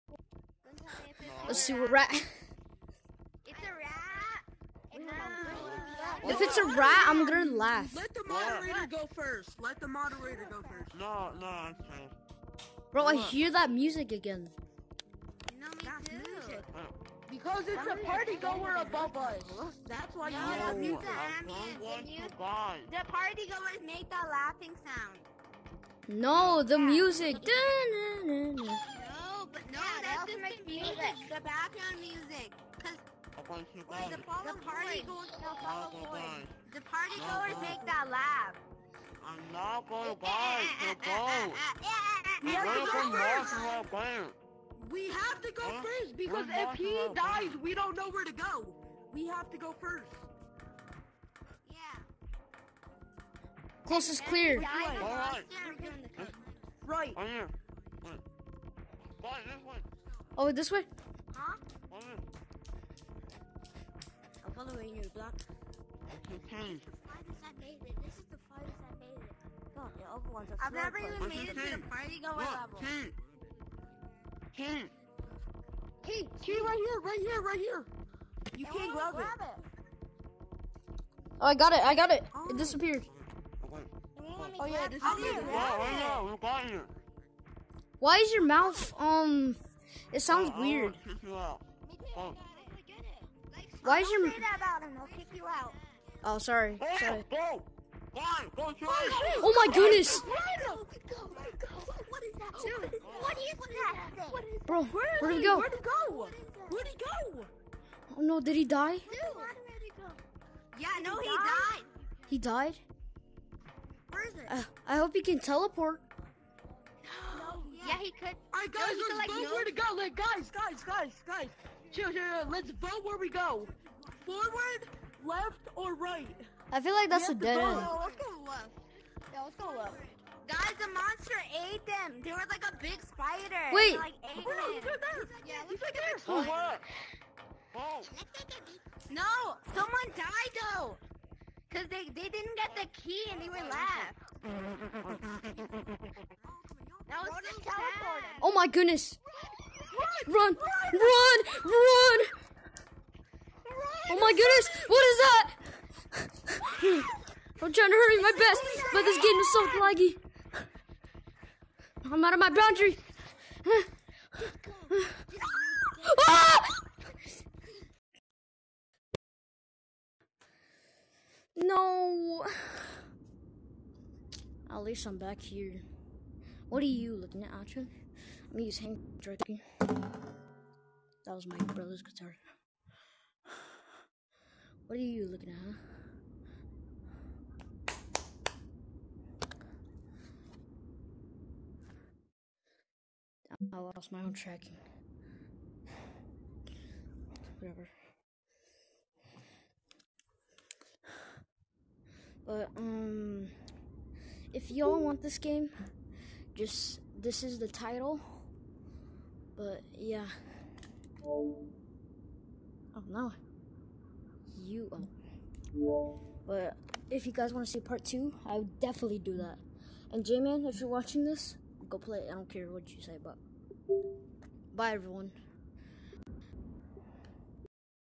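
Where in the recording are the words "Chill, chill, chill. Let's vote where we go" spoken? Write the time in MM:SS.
02:01.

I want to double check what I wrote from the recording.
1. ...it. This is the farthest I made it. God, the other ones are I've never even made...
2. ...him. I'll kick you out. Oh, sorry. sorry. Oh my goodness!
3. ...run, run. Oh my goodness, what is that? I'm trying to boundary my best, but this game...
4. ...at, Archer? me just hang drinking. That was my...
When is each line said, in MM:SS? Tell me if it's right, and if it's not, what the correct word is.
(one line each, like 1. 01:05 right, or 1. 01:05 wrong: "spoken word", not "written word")
1. 01:07 right
2. 01:34 right
3. 02:30 wrong: "hurry", not "boundary"
4. 02:57 right.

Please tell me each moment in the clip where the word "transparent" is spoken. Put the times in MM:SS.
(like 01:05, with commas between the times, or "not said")
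not said.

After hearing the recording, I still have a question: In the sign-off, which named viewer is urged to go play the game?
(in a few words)
J-Man.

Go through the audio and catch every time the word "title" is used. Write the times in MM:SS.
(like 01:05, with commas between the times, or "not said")
03:27.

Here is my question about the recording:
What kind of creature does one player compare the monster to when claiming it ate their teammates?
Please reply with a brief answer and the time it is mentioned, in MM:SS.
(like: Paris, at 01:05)
A big spider, at 02:12.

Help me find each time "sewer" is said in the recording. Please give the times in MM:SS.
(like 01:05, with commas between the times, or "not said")
00:01.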